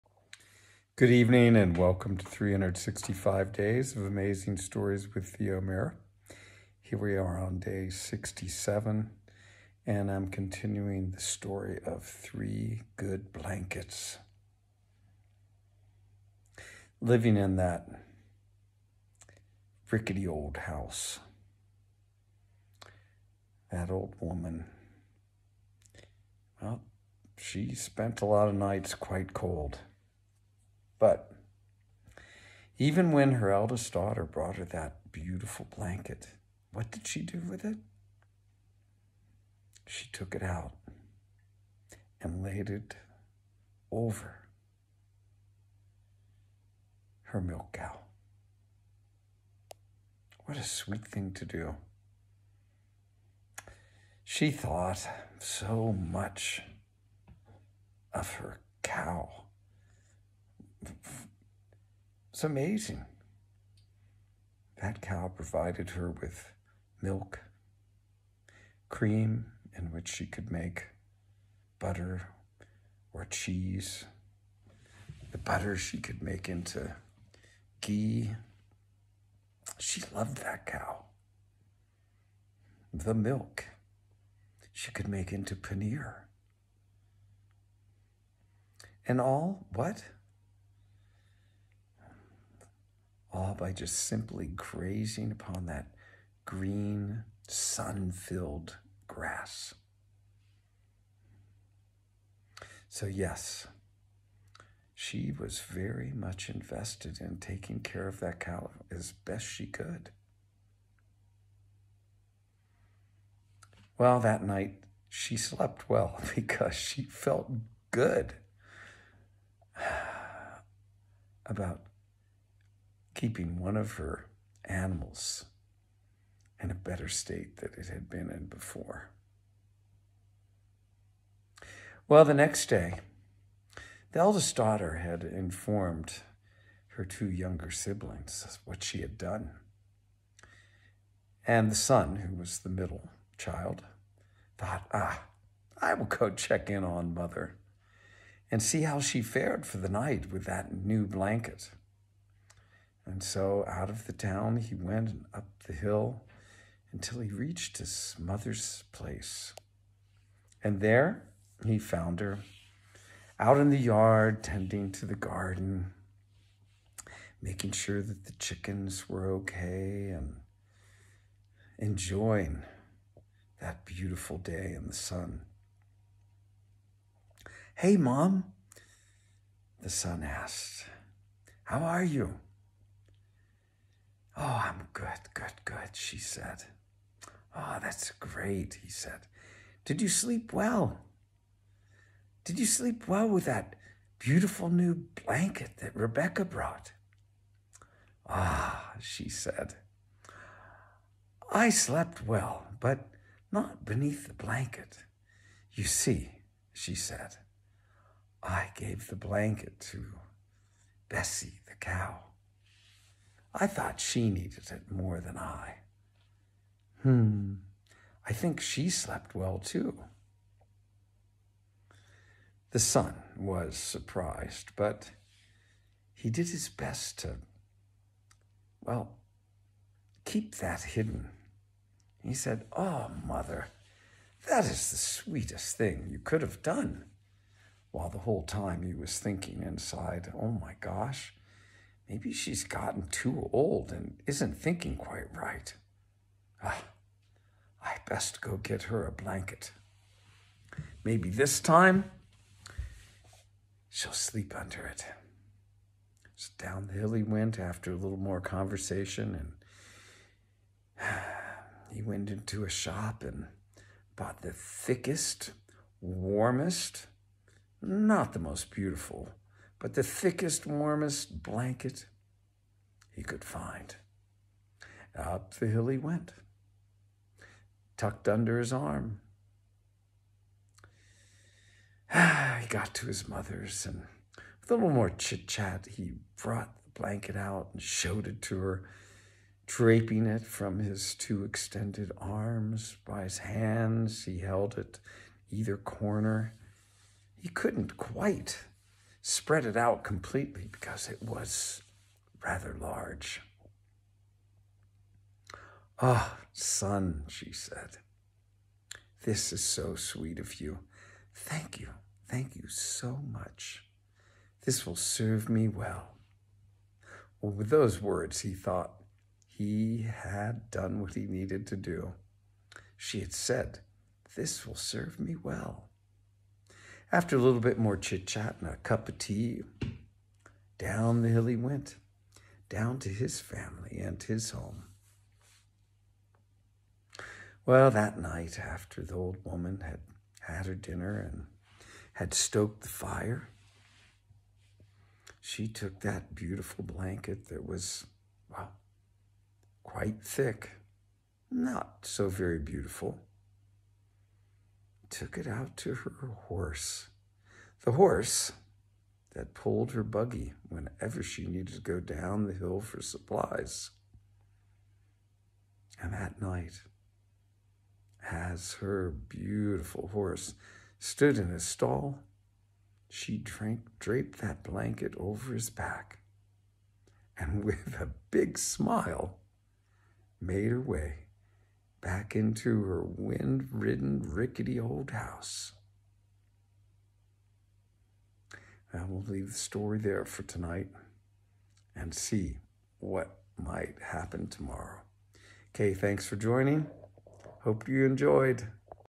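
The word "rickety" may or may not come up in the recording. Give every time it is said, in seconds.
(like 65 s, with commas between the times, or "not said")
19 s, 384 s.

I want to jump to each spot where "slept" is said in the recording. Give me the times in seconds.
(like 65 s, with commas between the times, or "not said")
115 s, 201 s, 218 s.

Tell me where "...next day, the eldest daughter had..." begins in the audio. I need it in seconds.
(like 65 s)
132 s.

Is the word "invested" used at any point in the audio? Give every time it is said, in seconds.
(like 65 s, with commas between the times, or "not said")
106 s.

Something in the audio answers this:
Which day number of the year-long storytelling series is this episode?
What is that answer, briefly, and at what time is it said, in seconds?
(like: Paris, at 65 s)
67, at 7 s.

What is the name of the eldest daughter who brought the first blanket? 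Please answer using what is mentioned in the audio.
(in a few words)
Rebecca.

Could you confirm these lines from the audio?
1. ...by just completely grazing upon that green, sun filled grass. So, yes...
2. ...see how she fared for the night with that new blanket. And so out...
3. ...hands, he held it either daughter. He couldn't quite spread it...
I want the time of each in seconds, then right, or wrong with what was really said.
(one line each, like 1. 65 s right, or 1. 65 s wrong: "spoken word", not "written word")
1. 93 s wrong: "simply", not "completely"
2. 148 s right
3. 293 s wrong: "corner", not "daughter".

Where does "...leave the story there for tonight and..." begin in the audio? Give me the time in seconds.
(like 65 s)
389 s.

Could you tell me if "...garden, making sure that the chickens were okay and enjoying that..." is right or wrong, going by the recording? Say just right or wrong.
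right.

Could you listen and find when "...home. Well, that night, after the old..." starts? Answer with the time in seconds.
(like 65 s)
334 s.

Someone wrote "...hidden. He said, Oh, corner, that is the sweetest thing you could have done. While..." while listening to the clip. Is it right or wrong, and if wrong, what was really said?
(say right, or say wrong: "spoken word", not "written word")
wrong: "mother", not "corner".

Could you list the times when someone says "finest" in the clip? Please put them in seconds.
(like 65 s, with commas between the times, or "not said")
not said.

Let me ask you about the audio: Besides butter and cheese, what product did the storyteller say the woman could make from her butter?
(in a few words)
Ghee.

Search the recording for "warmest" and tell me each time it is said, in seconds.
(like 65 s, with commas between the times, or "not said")
266 s, 270 s.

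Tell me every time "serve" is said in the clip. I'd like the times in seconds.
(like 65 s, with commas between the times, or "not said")
314 s, 324 s.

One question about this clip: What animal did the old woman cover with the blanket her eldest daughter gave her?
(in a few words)
Milk cow.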